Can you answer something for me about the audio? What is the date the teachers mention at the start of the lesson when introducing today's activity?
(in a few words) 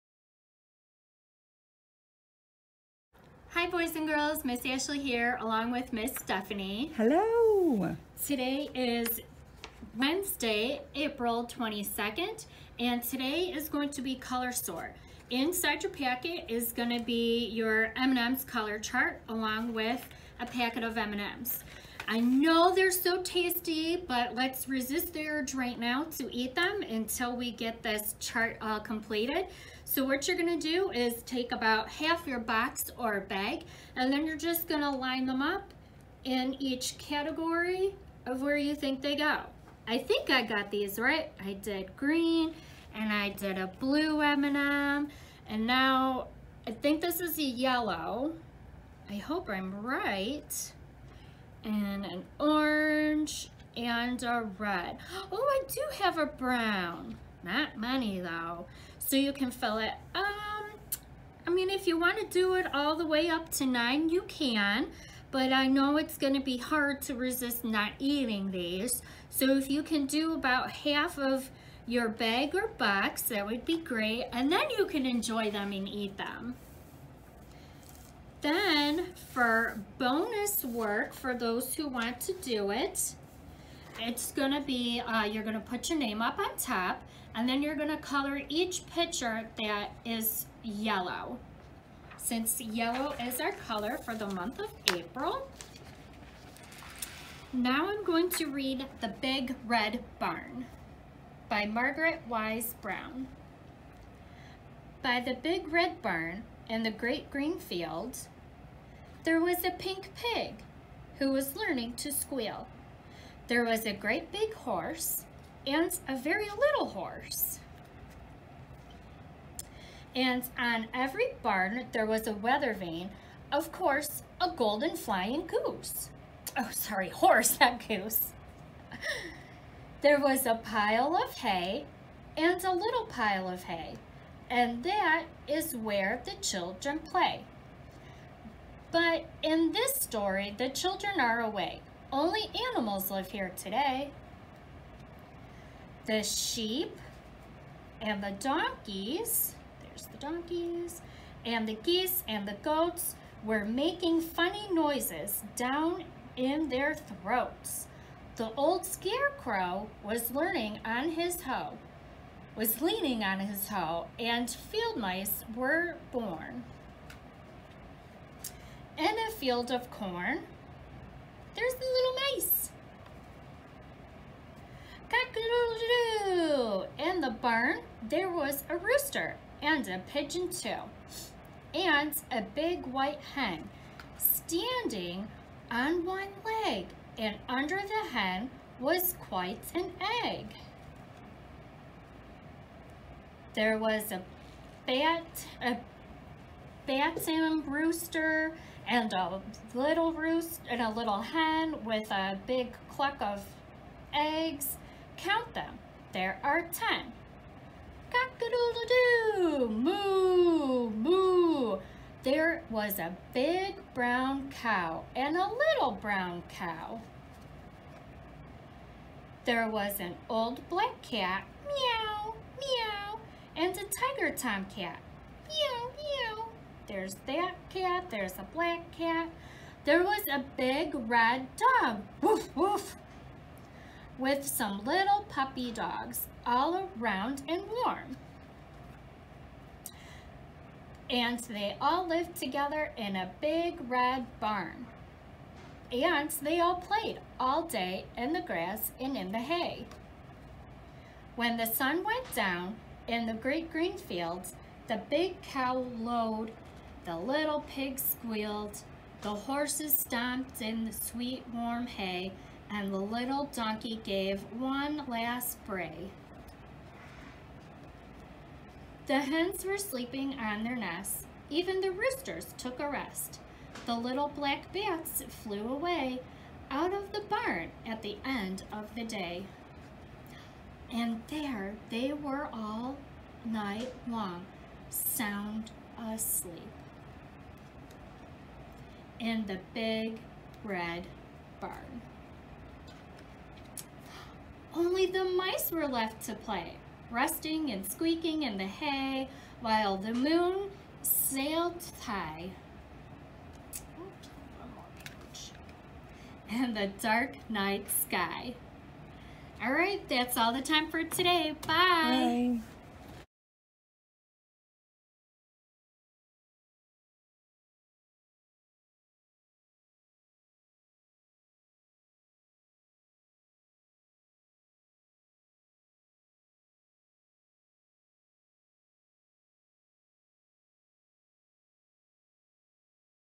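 April 22nd.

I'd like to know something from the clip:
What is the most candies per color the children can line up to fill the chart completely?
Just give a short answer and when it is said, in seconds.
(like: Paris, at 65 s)
9, at 63 s.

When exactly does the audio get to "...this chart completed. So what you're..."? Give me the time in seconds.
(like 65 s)
27 s.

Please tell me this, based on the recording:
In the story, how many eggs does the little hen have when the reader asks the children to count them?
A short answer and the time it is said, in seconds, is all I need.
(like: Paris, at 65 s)
10, at 206 s.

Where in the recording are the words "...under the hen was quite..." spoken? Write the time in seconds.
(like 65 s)
187 s.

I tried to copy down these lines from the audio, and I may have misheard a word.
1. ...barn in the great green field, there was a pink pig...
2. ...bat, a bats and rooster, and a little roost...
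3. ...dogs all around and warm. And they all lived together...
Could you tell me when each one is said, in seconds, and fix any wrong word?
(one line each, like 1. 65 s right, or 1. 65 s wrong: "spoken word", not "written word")
1. 106 s right
2. 194 s right
3. 235 s right.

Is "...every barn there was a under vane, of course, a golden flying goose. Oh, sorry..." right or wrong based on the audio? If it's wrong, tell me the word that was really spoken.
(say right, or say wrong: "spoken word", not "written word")
wrong: "weather", not "under".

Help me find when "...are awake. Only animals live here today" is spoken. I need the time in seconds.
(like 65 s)
141 s.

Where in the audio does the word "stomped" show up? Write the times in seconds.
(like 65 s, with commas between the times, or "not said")
259 s.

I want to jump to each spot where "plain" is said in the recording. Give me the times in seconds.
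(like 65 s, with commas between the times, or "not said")
not said.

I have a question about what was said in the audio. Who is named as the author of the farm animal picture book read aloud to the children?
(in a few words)
Margaret Wise Brown.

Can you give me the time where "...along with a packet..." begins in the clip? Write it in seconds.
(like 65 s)
19 s.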